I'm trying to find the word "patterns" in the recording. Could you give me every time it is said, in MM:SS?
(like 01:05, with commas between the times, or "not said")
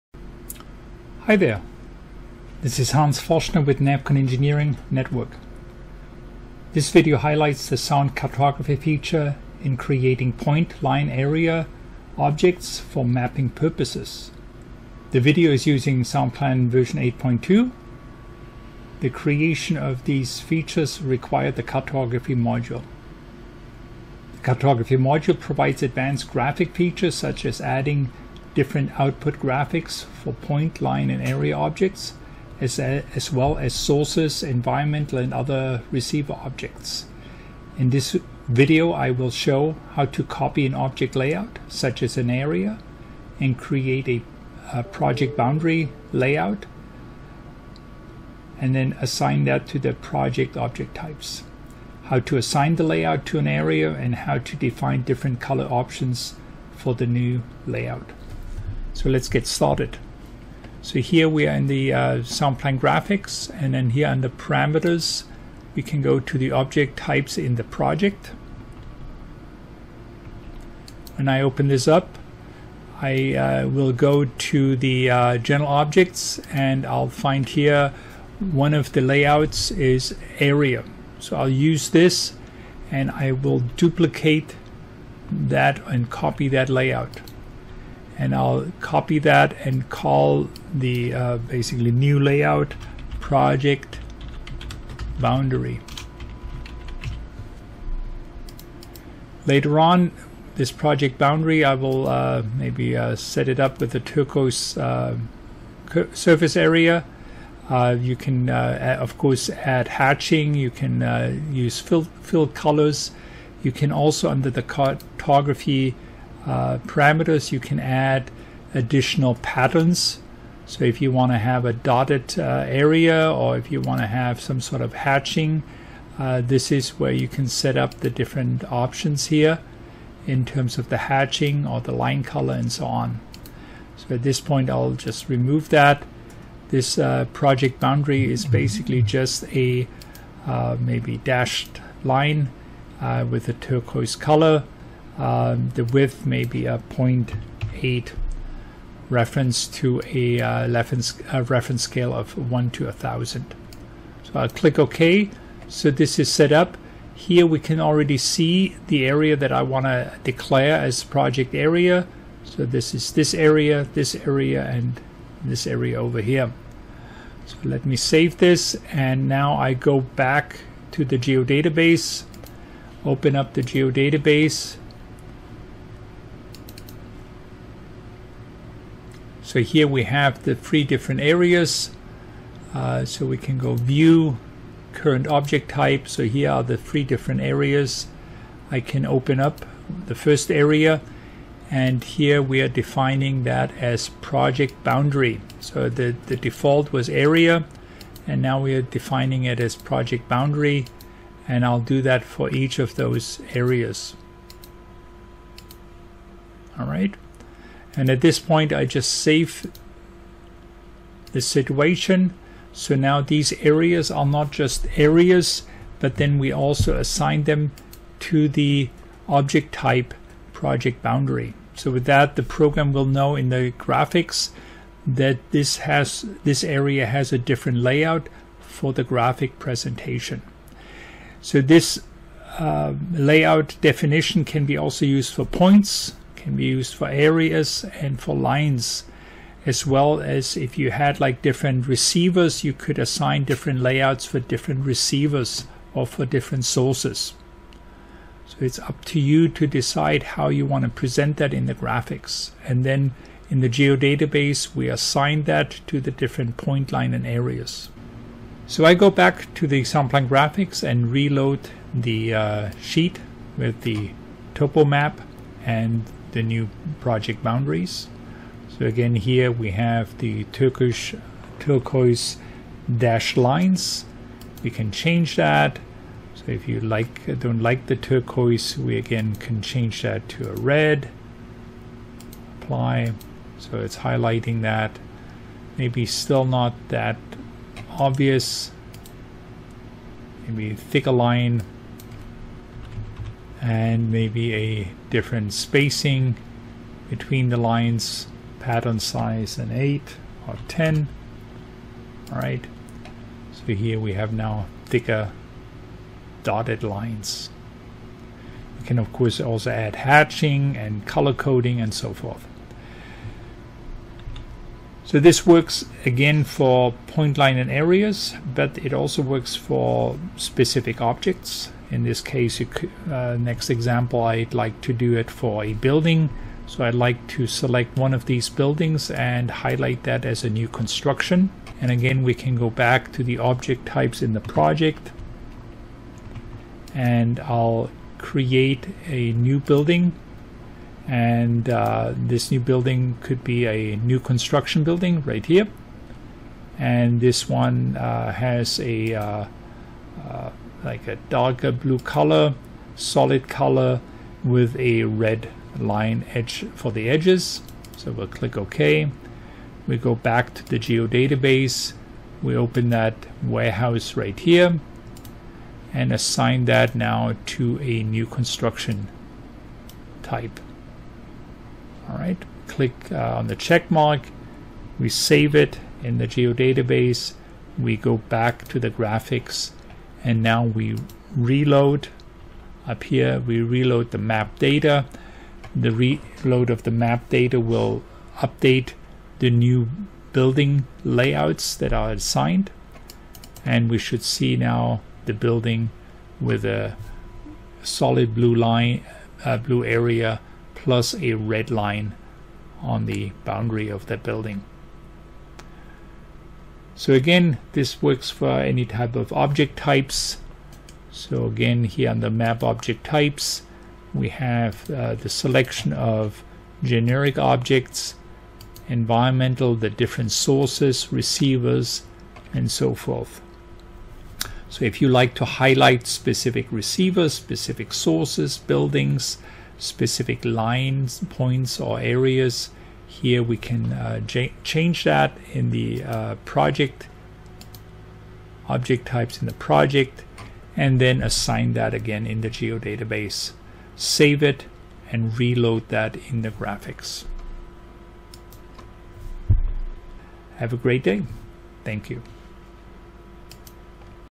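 01:59, 04:58.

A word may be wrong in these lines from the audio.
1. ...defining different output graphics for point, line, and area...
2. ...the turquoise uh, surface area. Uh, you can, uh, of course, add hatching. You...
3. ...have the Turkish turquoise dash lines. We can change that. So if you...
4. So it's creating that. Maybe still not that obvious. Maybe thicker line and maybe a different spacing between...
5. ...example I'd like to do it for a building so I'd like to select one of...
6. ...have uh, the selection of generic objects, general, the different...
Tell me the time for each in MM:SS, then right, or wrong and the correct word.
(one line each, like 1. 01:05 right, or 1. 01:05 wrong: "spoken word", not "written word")
1. 00:27 wrong: "adding", not "defining"
2. 01:43 right
3. 04:29 right
4. 04:43 wrong: "highlighting", not "creating"
5. 05:23 right
6. 06:54 wrong: "environmental", not "general".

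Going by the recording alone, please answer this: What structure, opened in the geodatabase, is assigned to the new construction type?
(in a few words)
warehouse.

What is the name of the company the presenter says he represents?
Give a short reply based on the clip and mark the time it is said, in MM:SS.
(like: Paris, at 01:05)
NAVCON Engineering Network, at 00:03.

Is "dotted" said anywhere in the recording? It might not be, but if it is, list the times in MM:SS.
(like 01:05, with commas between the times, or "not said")
02:01, 05:06.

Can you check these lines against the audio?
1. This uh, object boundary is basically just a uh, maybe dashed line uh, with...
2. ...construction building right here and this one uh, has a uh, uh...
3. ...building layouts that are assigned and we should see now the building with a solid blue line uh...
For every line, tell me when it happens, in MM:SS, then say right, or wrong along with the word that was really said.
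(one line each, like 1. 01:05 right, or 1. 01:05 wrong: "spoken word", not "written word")
1. 02:16 wrong: "project", not "object"
2. 05:44 right
3. 06:30 right.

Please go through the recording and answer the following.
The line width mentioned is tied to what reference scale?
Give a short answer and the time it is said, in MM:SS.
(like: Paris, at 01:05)
1 to 1000, at 02:32.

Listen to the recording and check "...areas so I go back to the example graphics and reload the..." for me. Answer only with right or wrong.
right.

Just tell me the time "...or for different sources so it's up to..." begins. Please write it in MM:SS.
04:05.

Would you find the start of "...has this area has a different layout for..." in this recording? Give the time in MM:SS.
03:45.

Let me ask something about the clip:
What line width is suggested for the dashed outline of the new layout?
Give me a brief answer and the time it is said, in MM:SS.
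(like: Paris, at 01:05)
0.8, at 02:26.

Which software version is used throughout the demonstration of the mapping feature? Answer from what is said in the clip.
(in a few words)
8.2.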